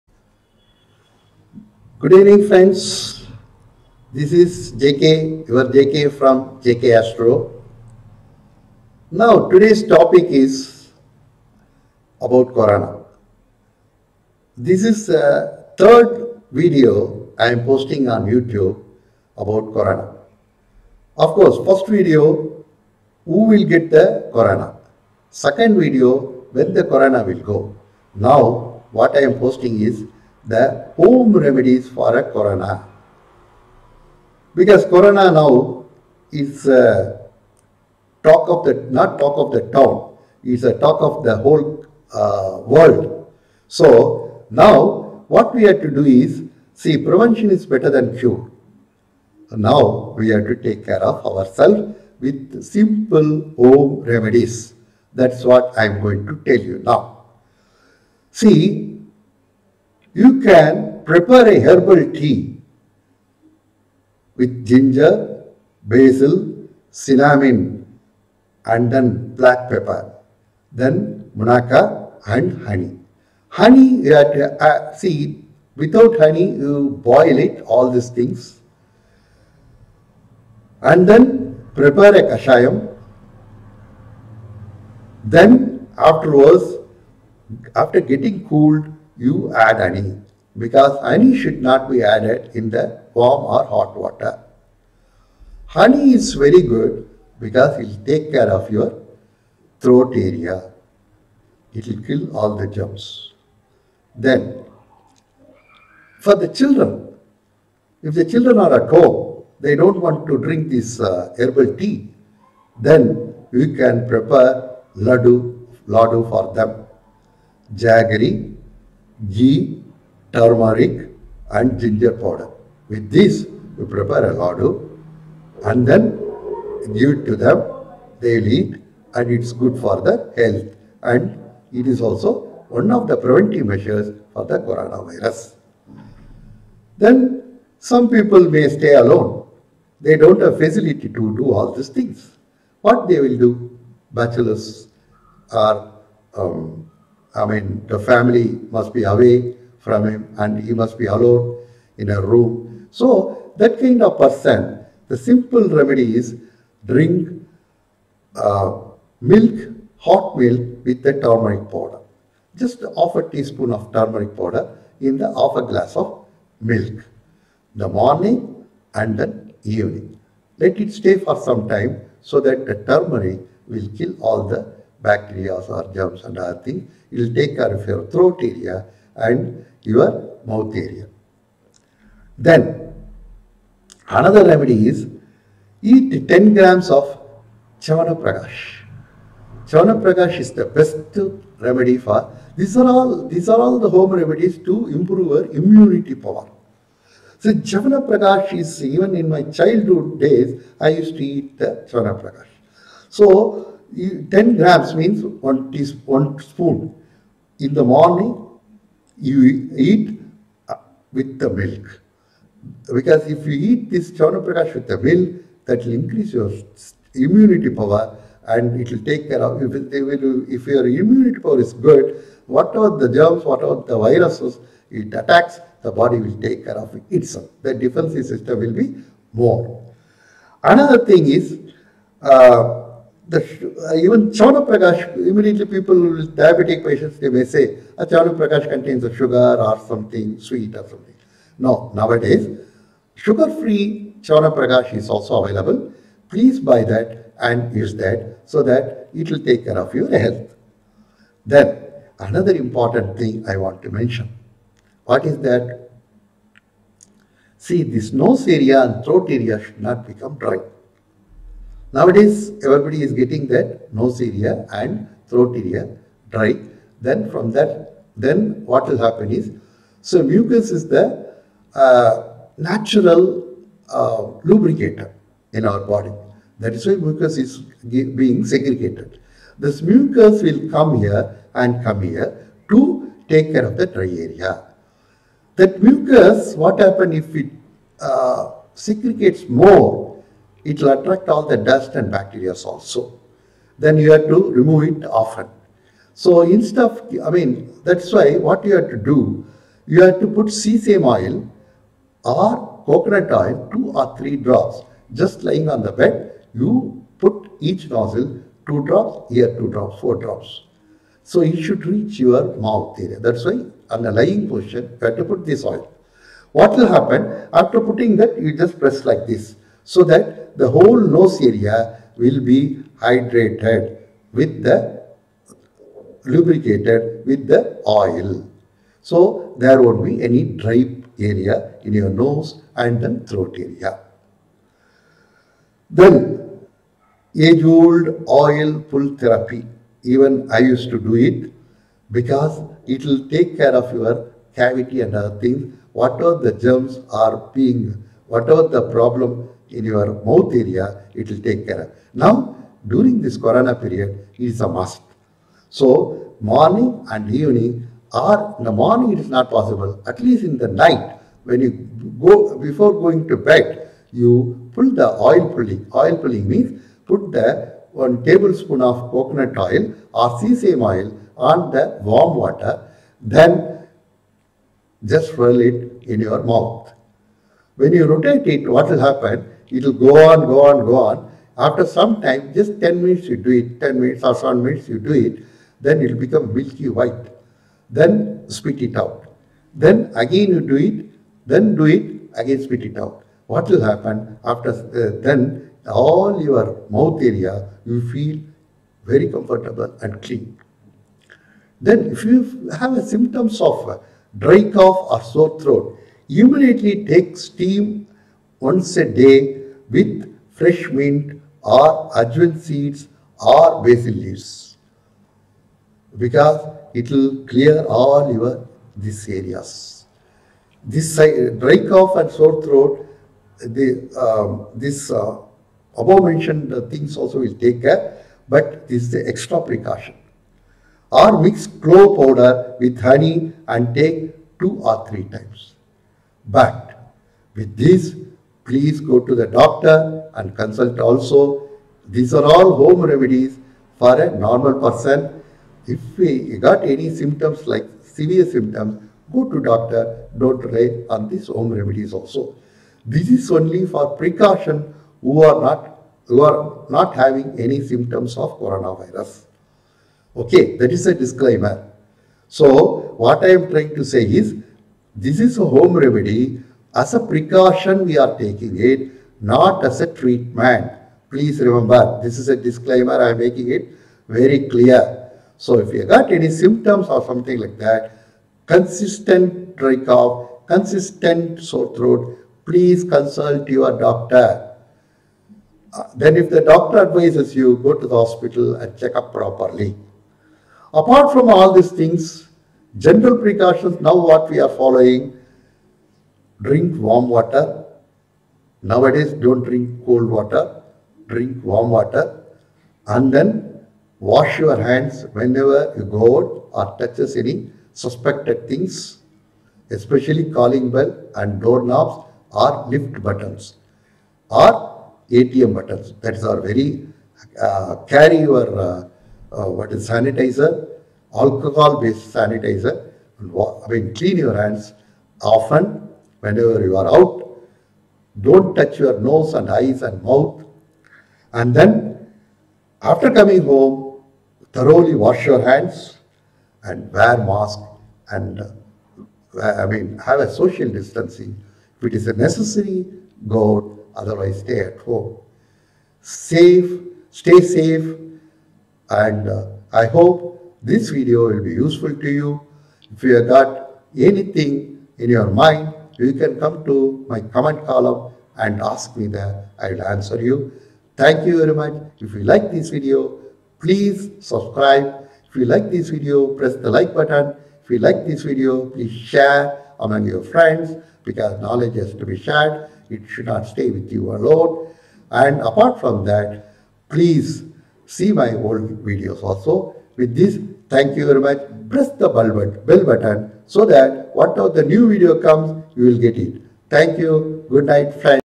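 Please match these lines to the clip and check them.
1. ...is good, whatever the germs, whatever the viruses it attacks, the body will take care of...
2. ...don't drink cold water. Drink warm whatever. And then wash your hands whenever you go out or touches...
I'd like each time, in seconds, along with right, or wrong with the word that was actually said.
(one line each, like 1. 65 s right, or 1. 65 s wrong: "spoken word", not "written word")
1. 221 s right
2. 499 s wrong: "water", not "whatever".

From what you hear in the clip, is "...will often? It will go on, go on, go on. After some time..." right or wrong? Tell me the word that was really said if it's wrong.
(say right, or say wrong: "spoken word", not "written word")
wrong: "happen", not "often".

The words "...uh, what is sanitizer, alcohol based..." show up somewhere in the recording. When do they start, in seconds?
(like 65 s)
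519 s.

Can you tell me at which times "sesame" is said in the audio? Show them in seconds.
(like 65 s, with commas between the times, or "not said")
300 s, 370 s.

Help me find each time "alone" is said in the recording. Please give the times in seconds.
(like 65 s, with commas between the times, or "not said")
138 s, 151 s, 574 s.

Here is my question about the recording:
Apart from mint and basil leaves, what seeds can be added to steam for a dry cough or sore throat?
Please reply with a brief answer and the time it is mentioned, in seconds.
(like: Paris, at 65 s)
Ajwain seeds, at 412 s.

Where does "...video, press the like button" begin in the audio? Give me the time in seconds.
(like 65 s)
566 s.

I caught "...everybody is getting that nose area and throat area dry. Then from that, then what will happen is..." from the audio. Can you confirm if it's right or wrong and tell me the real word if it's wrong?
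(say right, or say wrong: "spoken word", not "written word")
right.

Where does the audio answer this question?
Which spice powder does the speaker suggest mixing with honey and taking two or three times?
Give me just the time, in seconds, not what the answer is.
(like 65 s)
431 s.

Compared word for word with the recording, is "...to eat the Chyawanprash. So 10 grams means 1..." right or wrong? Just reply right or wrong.
right.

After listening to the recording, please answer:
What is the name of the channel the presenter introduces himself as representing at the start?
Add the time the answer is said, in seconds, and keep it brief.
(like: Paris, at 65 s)
JK Astro, at 6 s.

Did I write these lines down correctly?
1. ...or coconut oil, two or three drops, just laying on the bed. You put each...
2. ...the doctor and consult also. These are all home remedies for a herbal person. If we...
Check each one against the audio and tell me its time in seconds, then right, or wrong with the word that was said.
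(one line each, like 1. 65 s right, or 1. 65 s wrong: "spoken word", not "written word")
1. 302 s right
2. 439 s wrong: "normal", not "herbal".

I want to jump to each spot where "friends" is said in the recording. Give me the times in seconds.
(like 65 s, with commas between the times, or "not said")
2 s, 570 s, 588 s.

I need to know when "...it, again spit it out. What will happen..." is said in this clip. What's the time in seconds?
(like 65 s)
391 s.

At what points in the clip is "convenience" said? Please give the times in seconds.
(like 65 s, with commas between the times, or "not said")
not said.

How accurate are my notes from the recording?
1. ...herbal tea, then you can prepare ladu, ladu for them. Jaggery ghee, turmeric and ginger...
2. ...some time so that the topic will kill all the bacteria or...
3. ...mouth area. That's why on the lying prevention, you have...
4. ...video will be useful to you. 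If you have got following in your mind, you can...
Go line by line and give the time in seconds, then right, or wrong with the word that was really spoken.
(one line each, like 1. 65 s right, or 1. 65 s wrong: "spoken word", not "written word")
1. 111 s right
2. 171 s wrong: "turmeric", not "topic"
3. 312 s wrong: "position", not "prevention"
4. 551 s wrong: "anything", not "following".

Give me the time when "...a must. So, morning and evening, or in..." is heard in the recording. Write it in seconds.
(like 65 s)
354 s.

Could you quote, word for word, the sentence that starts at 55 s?
That's what I'm going to tell you now.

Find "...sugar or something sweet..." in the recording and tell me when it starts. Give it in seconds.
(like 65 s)
239 s.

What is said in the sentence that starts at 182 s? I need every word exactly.
Then another remedy is eat 10 grams of Chyawanprash.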